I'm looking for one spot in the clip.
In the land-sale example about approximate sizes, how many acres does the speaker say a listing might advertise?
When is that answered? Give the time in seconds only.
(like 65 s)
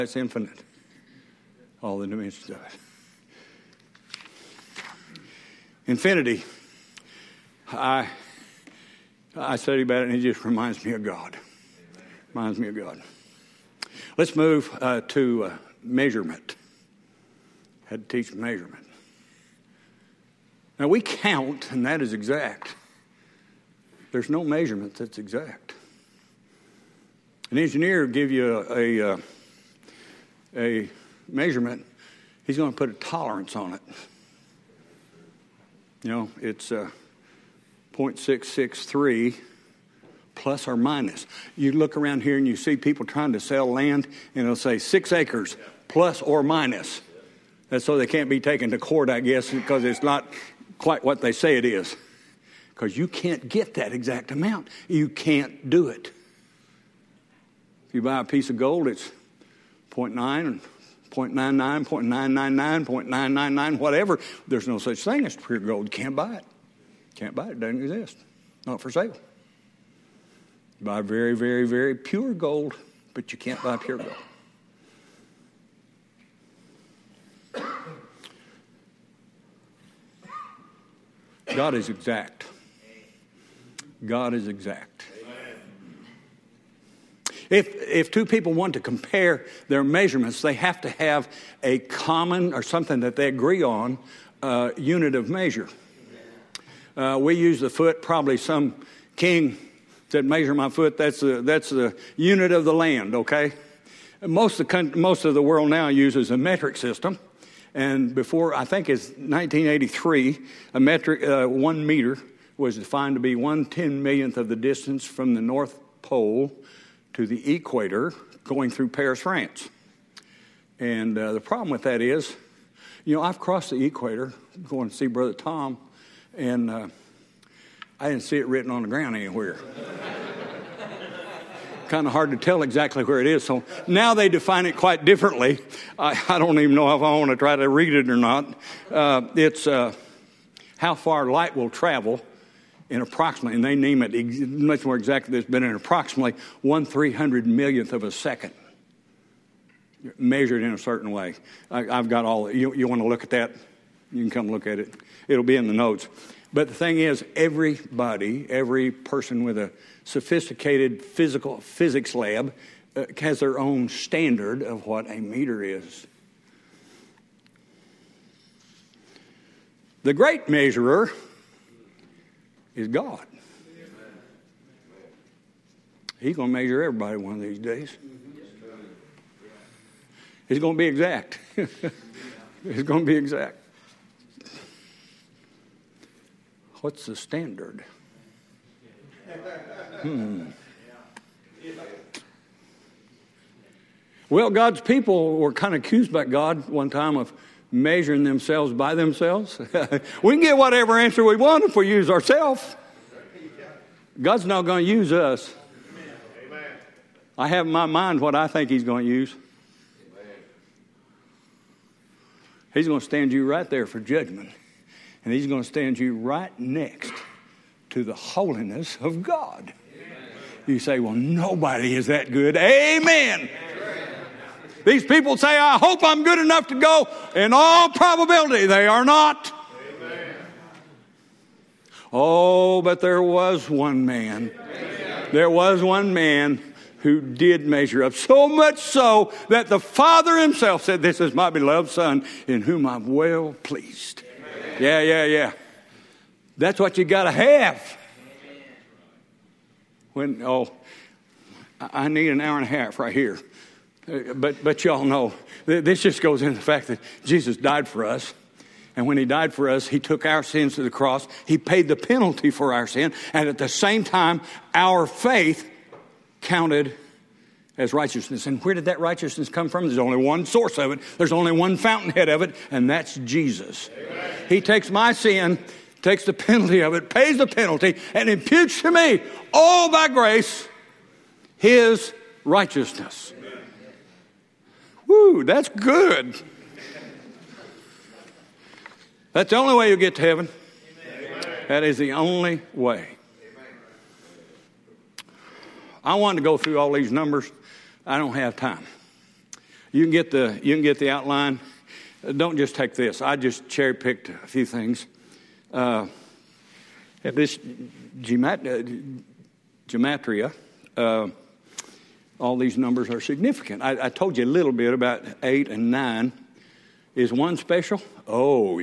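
44 s.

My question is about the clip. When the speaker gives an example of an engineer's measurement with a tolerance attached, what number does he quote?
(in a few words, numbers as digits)
0.663.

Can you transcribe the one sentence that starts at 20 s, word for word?
Now we count, and that is exact.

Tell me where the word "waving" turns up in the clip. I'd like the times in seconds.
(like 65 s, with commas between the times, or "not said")
not said.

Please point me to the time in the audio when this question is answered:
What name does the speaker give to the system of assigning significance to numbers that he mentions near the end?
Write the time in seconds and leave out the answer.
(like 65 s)
309 s.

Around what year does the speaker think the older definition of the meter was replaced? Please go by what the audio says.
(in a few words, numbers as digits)
1983.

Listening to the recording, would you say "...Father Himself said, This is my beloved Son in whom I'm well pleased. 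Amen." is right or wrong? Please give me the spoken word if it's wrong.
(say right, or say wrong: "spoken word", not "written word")
right.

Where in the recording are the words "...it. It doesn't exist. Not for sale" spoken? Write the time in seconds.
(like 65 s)
67 s.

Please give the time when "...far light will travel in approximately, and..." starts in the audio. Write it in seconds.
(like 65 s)
140 s.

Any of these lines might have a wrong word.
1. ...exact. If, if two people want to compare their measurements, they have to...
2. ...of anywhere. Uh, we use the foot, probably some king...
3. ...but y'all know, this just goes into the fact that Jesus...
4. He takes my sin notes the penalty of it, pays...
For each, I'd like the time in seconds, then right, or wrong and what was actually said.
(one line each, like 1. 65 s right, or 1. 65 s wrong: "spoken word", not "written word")
1. 84 s right
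2. 95 s wrong: "measure", not "anywhere"
3. 254 s right
4. 274 s wrong: "takes", not "notes".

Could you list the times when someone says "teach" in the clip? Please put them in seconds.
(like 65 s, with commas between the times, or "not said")
18 s.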